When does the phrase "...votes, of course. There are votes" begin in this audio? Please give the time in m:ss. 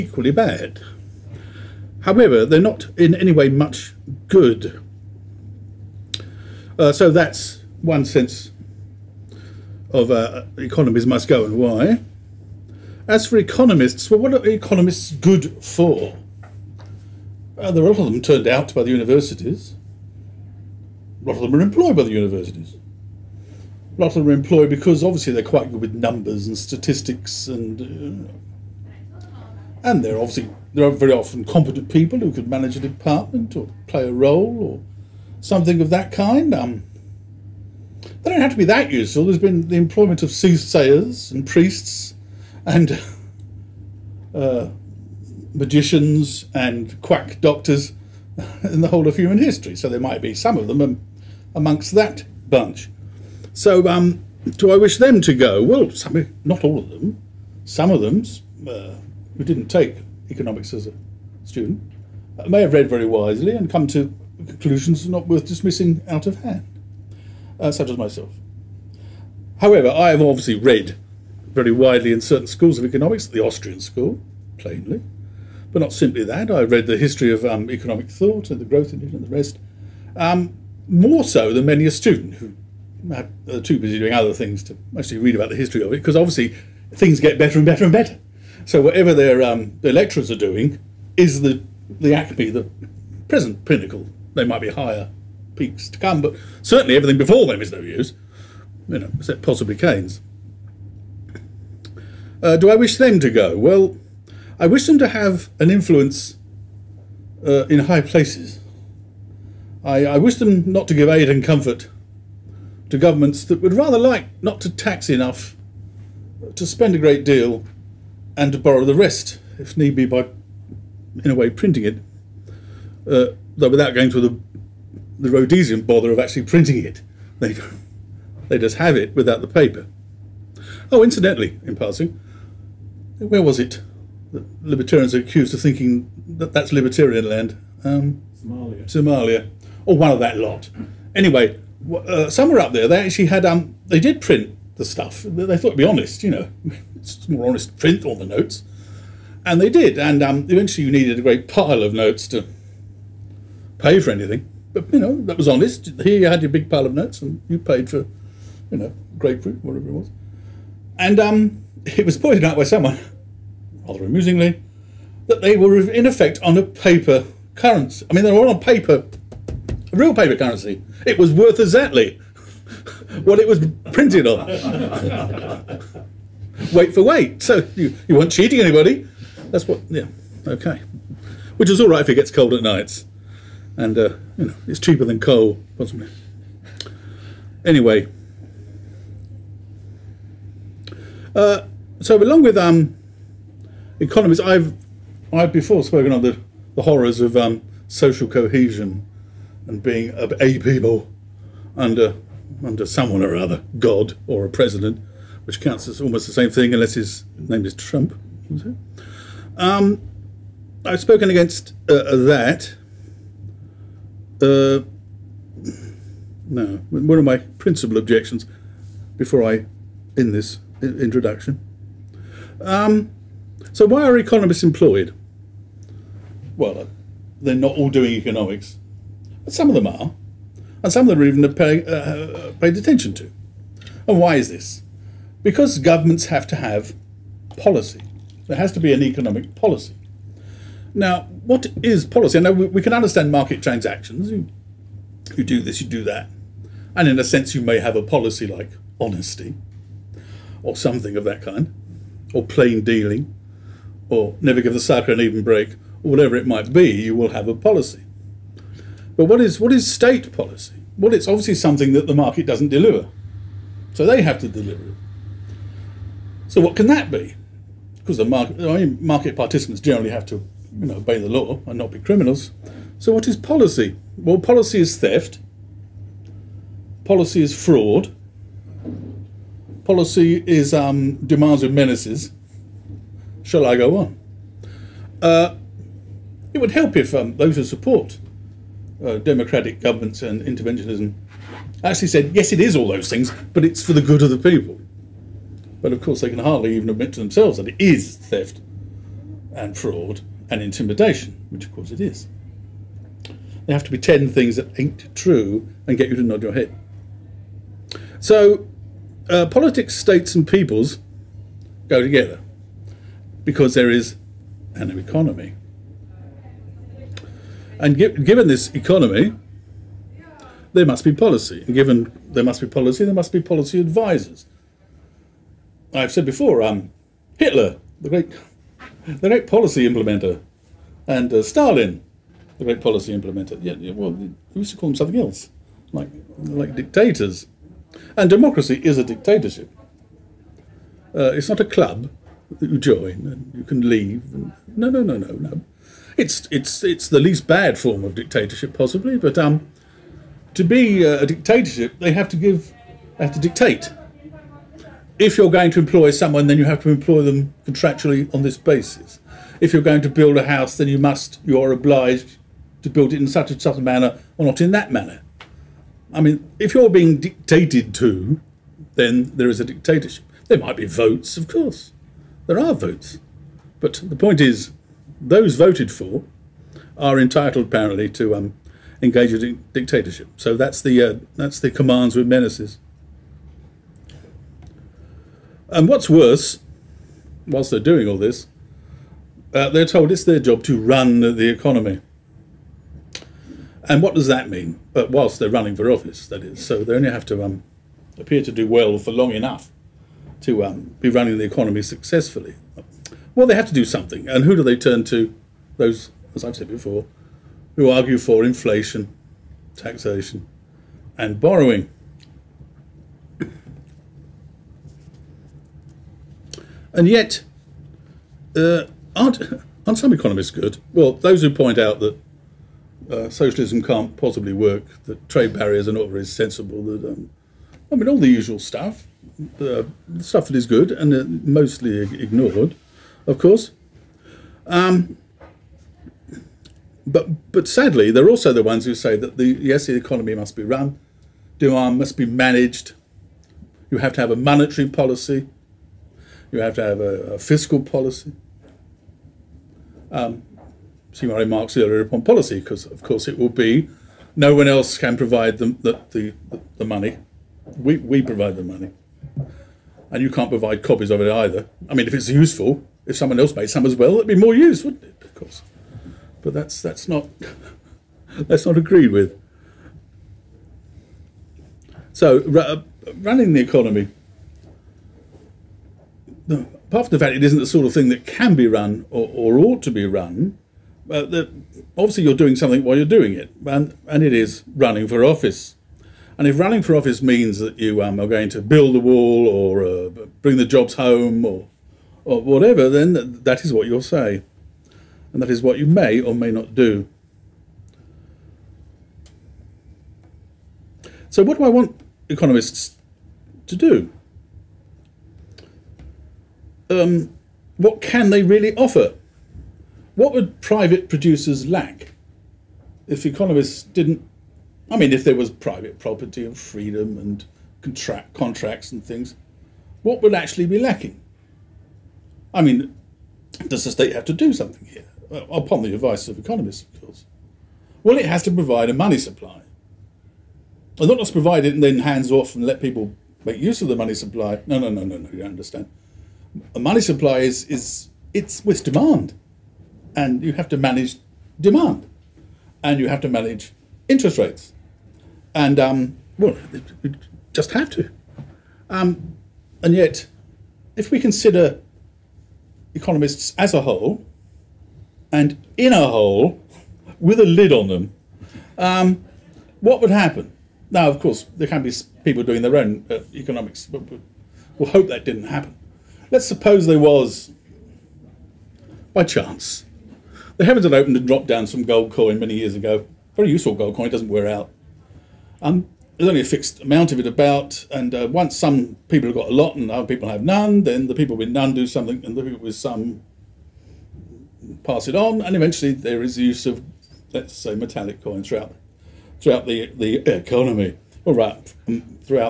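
6:10.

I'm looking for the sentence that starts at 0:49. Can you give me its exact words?
So there might be some of them amongst that bunch.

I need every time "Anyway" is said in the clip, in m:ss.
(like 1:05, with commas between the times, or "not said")
2:21, 3:07.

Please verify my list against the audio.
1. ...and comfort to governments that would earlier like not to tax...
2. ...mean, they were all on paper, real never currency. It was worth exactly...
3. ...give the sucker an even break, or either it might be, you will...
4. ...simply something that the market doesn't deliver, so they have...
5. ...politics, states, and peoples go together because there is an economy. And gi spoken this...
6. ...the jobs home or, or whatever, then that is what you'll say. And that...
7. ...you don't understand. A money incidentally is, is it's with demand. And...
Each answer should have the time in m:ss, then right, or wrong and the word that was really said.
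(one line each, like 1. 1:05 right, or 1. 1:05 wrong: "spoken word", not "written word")
1. 1:51 wrong: "rather", not "earlier"
2. 2:48 wrong: "paper", not "never"
3. 4:14 wrong: "whatever", not "either"
4. 4:21 wrong: "obviously", not "simply"
5. 5:09 wrong: "given", not "spoken"
6. 8:10 right
7. 8:55 wrong: "supply", not "incidentally".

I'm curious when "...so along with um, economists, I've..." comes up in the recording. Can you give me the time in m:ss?
3:11.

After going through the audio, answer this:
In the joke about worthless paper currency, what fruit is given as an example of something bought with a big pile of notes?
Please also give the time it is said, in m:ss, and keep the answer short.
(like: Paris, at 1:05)
grapefruit, at 2:39.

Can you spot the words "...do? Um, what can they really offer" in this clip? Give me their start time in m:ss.
8:23.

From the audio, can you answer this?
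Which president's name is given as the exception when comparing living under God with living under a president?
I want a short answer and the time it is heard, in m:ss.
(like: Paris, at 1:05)
Trump, at 3:27.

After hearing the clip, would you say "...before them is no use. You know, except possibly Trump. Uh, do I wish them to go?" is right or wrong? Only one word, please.
wrong.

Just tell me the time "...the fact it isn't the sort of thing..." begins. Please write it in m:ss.
7:57.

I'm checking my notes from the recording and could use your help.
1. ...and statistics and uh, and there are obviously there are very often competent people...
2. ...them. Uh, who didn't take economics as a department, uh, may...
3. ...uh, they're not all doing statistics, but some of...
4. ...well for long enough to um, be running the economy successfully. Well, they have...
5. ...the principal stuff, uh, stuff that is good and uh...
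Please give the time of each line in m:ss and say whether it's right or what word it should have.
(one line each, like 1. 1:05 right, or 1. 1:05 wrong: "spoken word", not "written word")
1. 0:26 right
2. 0:57 wrong: "student", not "department"
3. 3:46 wrong: "economics", not "statistics"
4. 6:38 right
5. 7:08 wrong: "usual", not "principal".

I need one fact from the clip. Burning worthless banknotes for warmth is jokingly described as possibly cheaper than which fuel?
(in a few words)
coal.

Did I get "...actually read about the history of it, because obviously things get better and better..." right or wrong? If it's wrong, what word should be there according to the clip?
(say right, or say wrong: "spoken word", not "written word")
right.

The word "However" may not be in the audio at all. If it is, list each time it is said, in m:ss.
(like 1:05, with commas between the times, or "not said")
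0:02, 1:09.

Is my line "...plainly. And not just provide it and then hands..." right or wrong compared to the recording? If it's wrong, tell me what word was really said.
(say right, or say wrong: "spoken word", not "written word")
wrong: "supply", not "plainly".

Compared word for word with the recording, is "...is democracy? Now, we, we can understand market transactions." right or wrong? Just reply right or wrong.
wrong.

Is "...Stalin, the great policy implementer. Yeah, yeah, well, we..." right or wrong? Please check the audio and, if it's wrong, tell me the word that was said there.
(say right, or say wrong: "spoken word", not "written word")
right.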